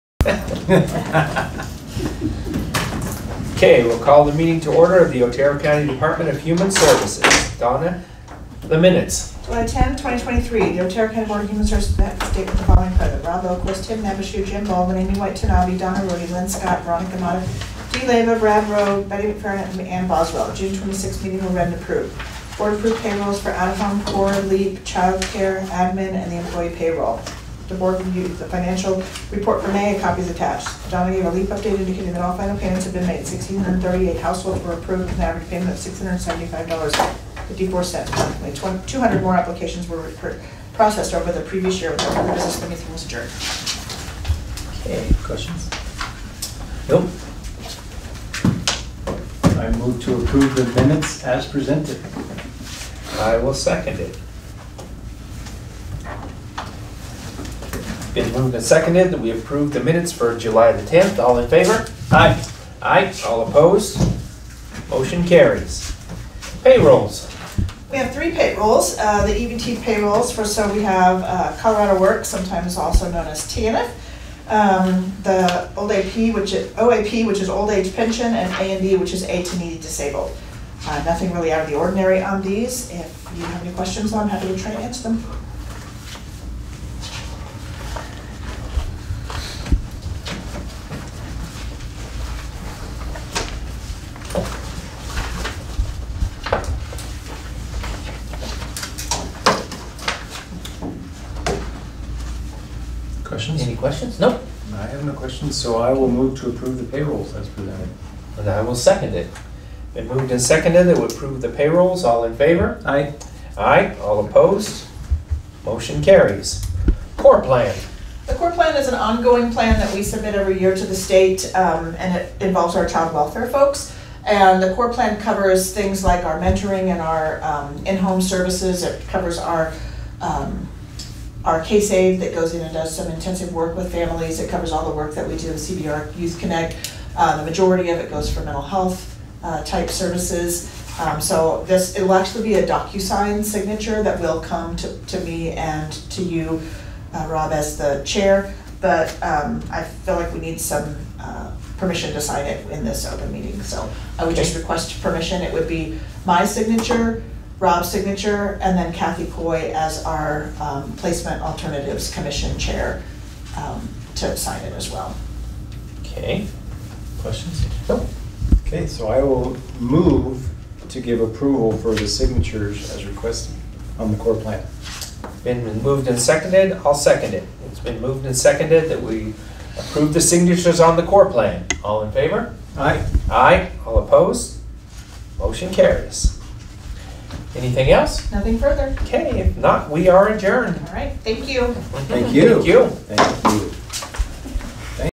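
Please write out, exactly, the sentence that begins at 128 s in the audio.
It covers our um, our case aid that goes in and does some intensive work with families.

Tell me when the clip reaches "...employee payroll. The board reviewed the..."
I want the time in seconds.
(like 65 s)
26 s.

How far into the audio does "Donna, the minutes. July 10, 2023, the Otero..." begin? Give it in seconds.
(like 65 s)
7 s.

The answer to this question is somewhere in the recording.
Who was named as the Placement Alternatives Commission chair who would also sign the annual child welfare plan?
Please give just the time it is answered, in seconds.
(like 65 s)
158 s.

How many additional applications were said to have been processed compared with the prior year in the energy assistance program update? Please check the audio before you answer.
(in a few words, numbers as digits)
200.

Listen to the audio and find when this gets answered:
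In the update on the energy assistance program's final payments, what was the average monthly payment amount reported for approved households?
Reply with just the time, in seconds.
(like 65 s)
35 s.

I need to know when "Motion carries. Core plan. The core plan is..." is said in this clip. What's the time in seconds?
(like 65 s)
115 s.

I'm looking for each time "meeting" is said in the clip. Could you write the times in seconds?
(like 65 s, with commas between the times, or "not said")
4 s, 21 s, 153 s.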